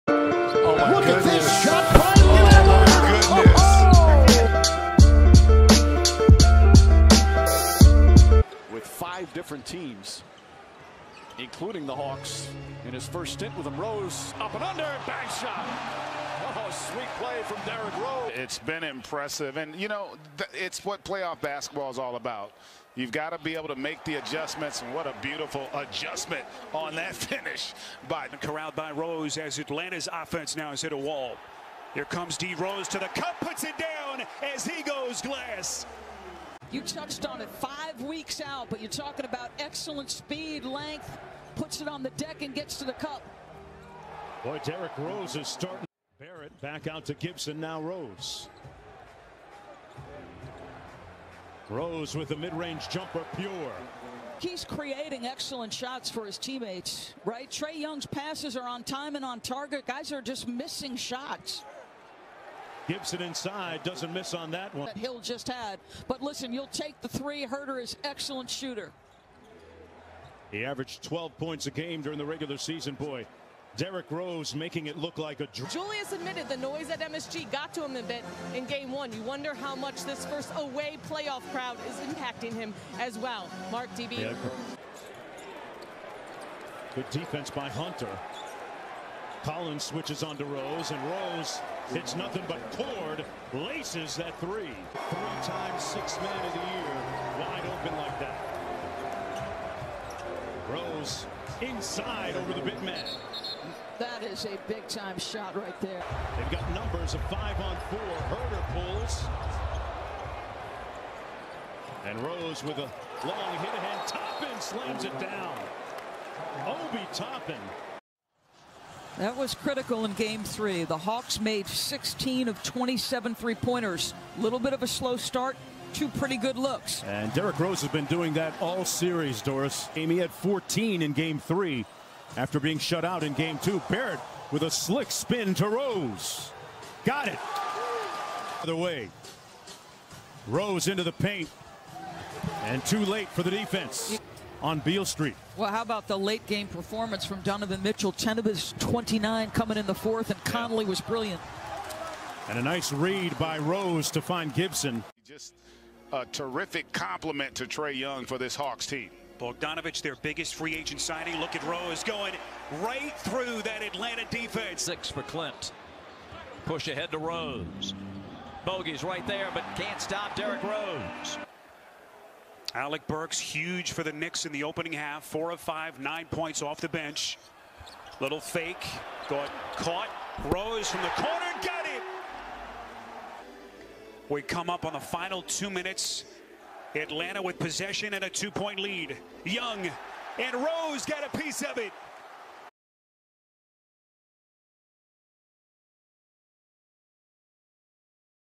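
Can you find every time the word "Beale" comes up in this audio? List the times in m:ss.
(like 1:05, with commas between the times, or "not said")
2:24.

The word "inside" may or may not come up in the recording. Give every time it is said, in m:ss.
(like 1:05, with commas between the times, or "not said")
1:03, 1:41.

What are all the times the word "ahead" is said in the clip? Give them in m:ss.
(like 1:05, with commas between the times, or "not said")
1:53, 2:46.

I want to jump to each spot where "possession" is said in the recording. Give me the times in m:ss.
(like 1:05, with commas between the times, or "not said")
3:07.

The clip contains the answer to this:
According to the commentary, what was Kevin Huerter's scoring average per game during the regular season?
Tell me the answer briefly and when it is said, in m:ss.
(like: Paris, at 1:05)
12 points, at 1:11.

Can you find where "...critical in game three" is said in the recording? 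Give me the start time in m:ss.
1:59.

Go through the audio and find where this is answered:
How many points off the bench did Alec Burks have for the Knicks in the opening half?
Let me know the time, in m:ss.
2:55.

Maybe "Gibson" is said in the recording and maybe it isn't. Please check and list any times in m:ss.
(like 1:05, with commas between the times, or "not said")
0:47, 1:02, 2:34.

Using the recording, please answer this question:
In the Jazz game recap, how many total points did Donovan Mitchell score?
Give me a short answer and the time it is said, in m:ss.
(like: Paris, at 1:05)
29, at 2:28.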